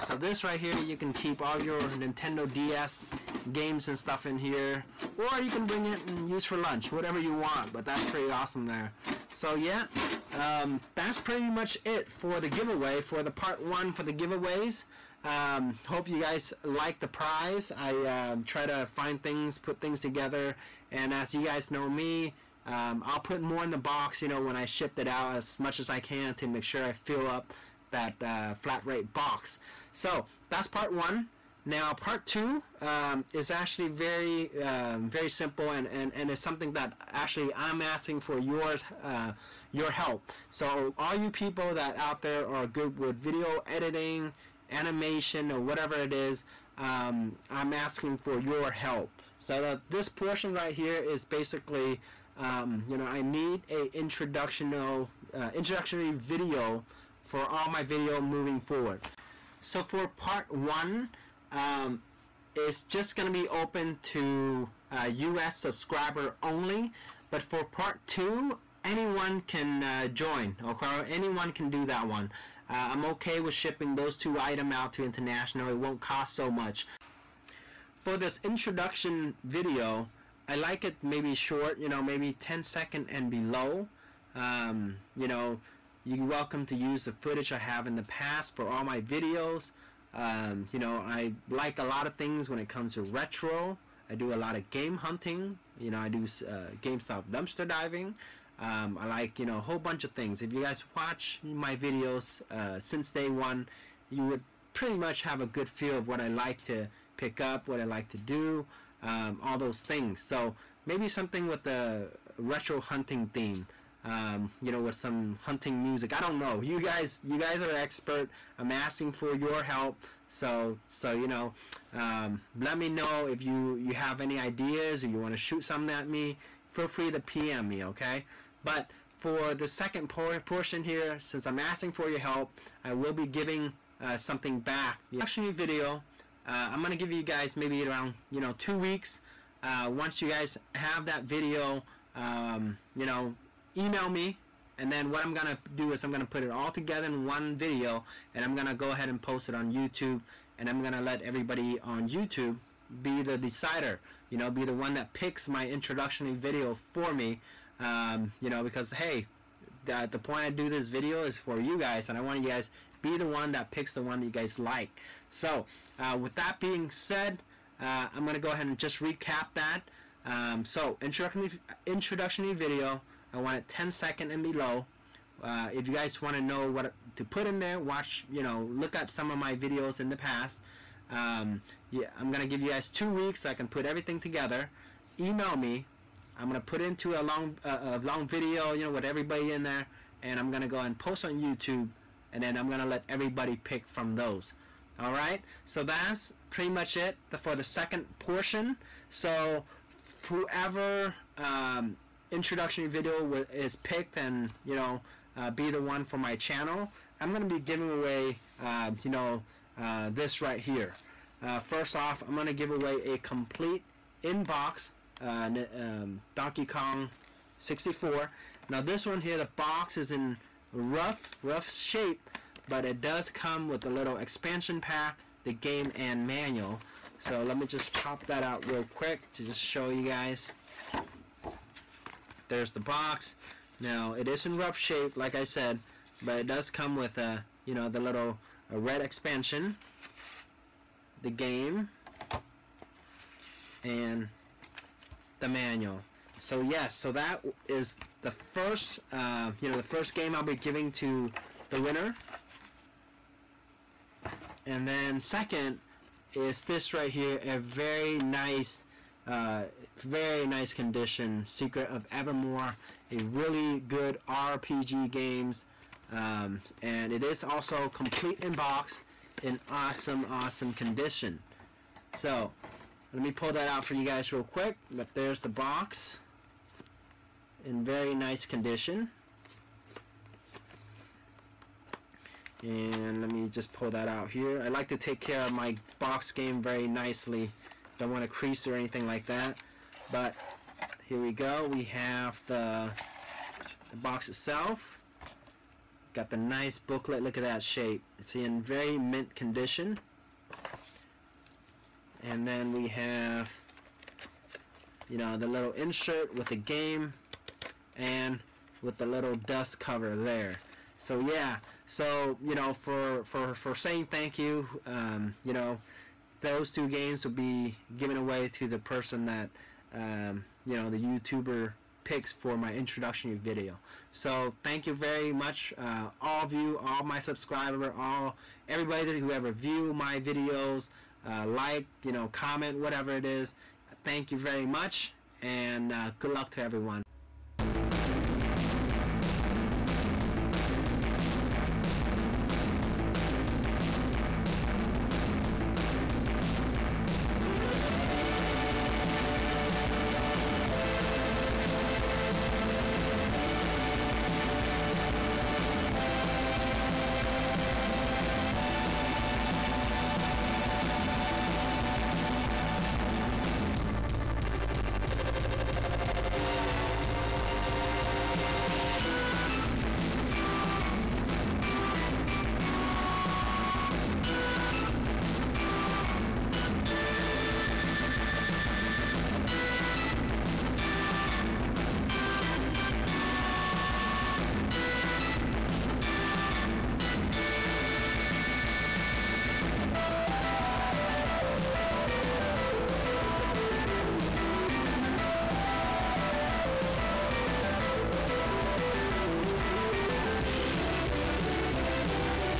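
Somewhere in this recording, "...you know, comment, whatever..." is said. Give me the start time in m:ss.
5:32.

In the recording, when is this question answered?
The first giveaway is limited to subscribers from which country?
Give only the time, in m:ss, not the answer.
1:05.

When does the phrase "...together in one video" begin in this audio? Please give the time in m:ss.
2:26.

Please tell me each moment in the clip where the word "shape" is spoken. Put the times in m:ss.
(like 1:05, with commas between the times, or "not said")
3:41, 3:54, 4:57.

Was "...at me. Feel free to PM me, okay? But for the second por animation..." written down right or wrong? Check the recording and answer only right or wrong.
wrong.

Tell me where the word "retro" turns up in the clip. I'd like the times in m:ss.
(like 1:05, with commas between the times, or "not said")
1:33, 1:52.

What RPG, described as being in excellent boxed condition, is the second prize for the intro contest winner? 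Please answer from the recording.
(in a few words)
Secret of Evermore.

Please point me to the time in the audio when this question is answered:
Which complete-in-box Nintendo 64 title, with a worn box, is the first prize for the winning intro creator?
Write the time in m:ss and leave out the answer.
3:36.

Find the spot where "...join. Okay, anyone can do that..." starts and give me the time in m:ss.
1:10.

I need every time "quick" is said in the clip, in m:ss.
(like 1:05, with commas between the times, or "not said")
3:48, 4:34.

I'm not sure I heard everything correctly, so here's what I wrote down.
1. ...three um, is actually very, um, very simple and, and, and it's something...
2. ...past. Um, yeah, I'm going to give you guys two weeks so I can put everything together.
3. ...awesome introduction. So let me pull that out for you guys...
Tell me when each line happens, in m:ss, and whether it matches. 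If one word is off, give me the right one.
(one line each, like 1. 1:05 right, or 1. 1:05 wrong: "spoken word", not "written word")
1. 0:32 wrong: "two", not "three"
2. 3:00 right
3. 4:30 wrong: "condition", not "introduction".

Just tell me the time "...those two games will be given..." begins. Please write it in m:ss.
5:16.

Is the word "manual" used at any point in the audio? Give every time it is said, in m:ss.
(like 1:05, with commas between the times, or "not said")
3:46, 4:05.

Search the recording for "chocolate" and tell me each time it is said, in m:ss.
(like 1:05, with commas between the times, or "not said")
not said.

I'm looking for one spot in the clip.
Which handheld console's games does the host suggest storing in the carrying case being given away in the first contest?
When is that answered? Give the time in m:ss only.
0:01.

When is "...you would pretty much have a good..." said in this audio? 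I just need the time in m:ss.
1:44.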